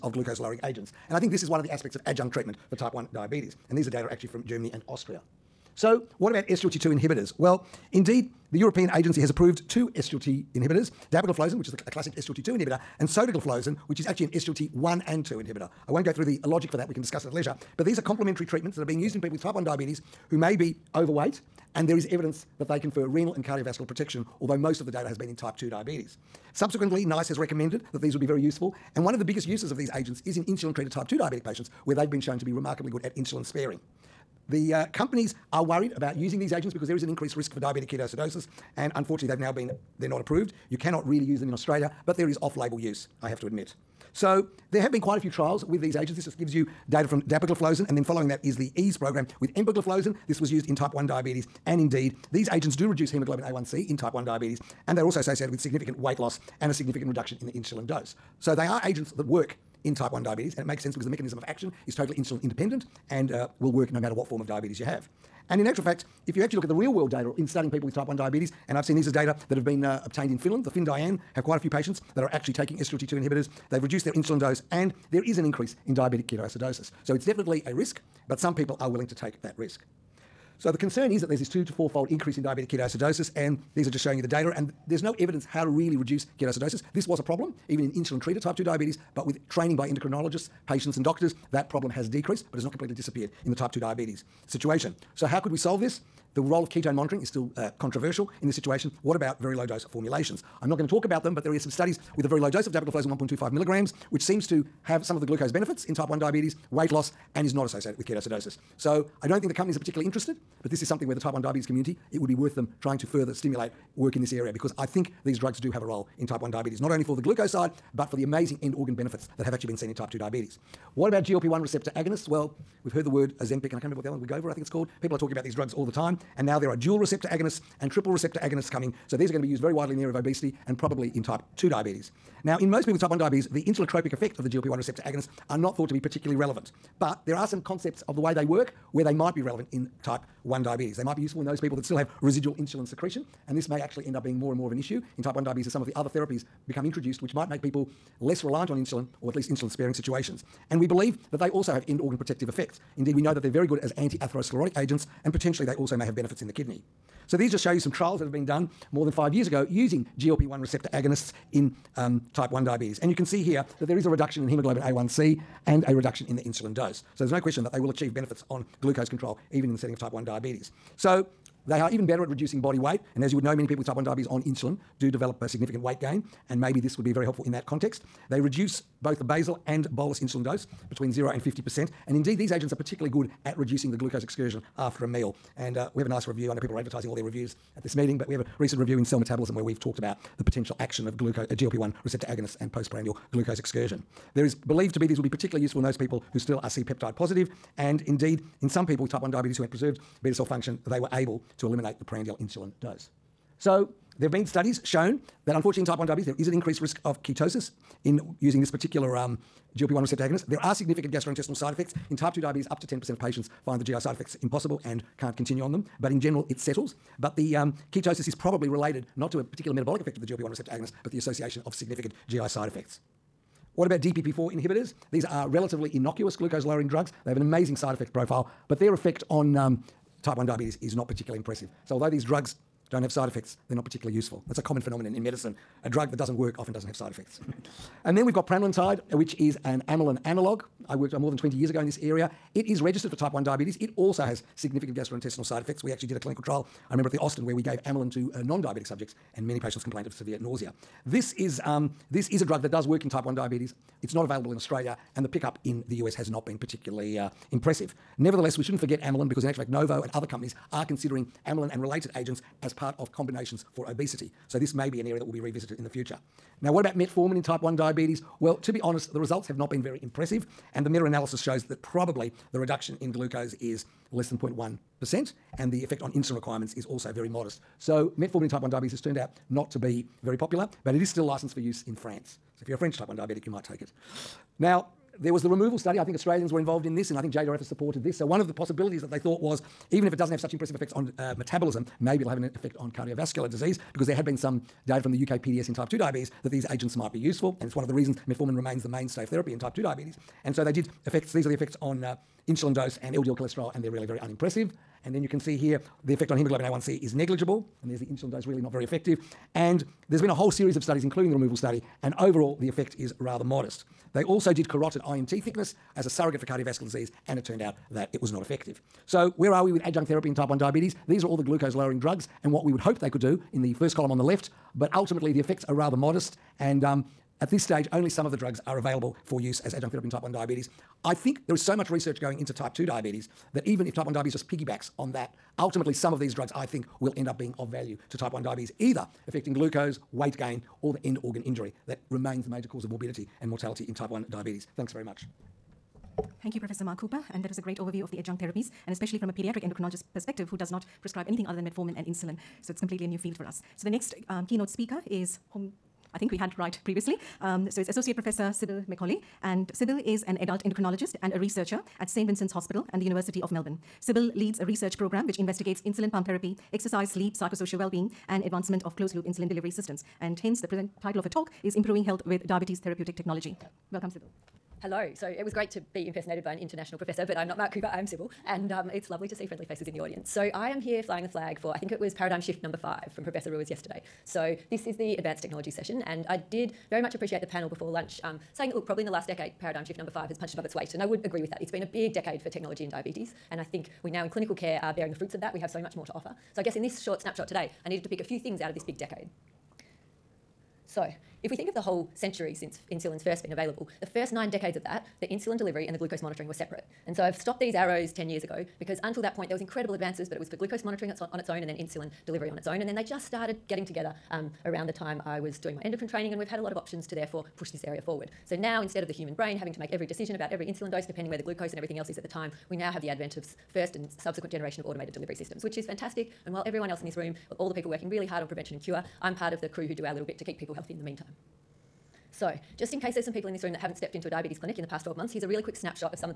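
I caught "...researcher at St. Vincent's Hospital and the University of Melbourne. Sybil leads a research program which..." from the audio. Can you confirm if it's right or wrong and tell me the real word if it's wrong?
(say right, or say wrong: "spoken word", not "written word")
right.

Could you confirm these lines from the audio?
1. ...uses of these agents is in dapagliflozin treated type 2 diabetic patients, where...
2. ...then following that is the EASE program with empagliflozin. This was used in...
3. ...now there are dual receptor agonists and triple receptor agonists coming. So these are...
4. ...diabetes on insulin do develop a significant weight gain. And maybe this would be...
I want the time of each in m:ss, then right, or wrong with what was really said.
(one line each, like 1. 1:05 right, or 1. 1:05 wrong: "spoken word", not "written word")
1. 0:29 wrong: "insulin", not "dapagliflozin"
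2. 0:47 right
3. 2:06 right
4. 2:54 right.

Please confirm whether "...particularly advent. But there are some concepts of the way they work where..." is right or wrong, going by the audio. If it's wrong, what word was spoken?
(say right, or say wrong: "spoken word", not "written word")
wrong: "relevant", not "advent".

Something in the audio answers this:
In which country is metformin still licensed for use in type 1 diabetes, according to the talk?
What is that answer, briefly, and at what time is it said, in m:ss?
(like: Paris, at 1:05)
France, at 4:41.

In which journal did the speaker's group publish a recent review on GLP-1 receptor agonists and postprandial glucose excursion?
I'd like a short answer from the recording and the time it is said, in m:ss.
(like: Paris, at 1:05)
Cell Metabolism, at 3:09.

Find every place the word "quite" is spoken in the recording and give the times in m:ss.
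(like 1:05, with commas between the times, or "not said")
0:45, 1:11.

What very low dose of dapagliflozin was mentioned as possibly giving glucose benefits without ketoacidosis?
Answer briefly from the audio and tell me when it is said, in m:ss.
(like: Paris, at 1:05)
1.25 milligrams, at 1:43.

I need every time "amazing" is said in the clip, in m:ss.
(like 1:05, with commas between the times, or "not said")
1:58, 3:47.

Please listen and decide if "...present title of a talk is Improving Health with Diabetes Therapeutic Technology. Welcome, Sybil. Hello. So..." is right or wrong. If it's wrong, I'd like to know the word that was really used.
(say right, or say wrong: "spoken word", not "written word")
right.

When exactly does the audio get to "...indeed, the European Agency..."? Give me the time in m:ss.
0:07.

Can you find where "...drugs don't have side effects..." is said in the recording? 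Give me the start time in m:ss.
3:52.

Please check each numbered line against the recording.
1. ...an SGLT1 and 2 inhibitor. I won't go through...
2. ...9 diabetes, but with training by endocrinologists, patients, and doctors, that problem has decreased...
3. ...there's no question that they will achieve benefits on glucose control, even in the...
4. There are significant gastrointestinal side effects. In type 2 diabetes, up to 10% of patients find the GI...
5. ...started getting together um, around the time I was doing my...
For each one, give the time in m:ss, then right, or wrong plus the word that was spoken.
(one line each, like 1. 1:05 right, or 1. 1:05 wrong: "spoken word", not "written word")
1. 0:14 right
2. 1:28 wrong: "2", not "9"
3. 2:47 right
4. 3:30 right
5. 6:53 right.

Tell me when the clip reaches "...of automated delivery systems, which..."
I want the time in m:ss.
7:04.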